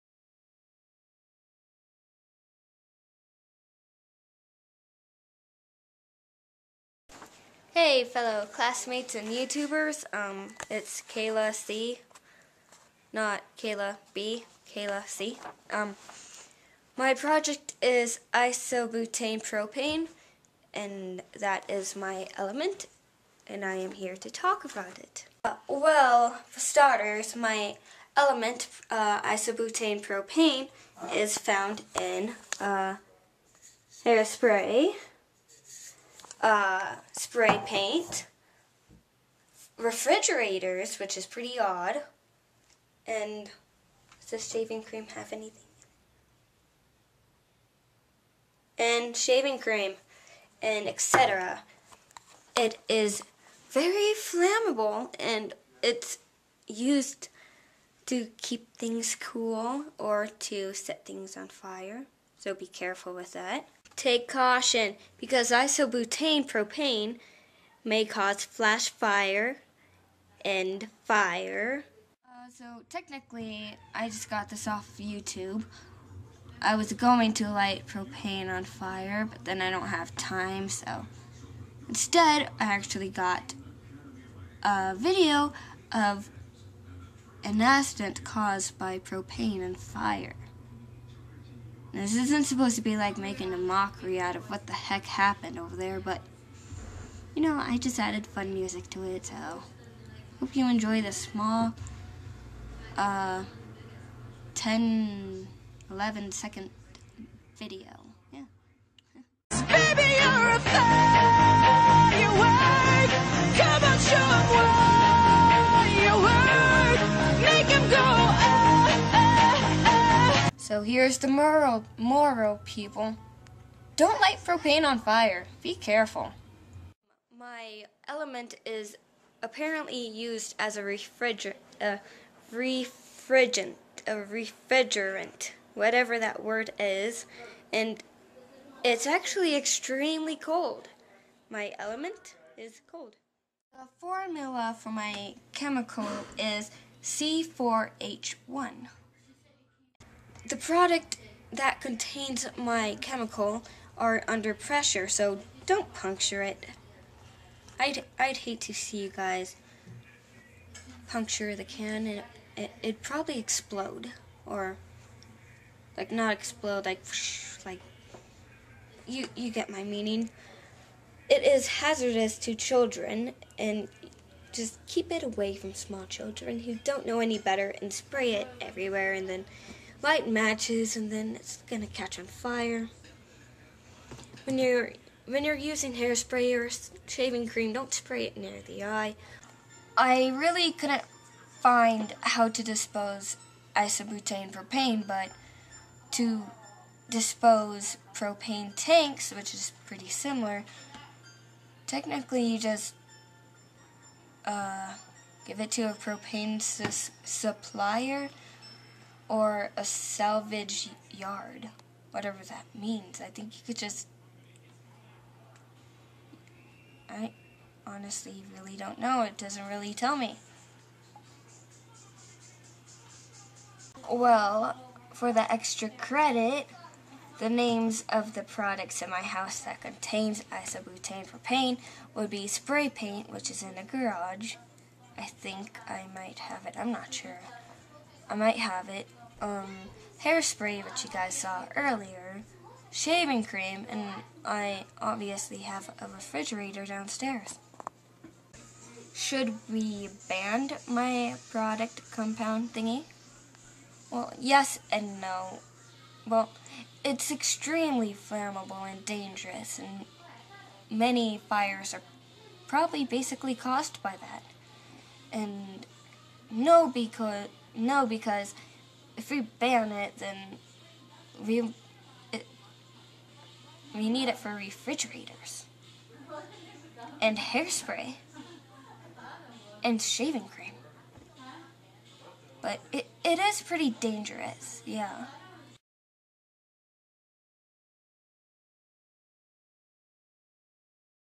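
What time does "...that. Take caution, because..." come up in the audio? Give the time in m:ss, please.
1:03.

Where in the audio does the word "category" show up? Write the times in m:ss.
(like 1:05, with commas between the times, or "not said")
not said.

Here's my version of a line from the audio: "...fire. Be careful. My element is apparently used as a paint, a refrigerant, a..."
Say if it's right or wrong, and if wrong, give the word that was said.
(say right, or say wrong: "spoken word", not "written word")
wrong: "refrigerant", not "paint".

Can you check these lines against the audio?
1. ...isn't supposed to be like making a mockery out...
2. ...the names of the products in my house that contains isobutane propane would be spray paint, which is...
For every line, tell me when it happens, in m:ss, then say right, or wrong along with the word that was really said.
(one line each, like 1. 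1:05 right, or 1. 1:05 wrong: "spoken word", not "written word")
1. 1:32 right
2. 3:47 right.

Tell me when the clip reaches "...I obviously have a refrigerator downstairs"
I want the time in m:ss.
4:04.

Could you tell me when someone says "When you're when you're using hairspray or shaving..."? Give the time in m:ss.
3:04.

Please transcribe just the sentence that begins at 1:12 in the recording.
Uh, so technically, I just got this off YouTube.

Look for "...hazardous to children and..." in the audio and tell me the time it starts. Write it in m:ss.
2:51.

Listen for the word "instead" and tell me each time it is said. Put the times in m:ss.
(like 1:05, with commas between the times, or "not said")
1:21.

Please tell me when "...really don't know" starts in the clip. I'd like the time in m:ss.
3:38.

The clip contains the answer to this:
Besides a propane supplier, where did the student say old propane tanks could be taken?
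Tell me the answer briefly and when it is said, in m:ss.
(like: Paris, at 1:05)
salvage yard, at 3:29.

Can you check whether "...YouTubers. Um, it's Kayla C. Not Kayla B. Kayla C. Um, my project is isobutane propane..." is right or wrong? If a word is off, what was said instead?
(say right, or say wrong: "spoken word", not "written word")
right.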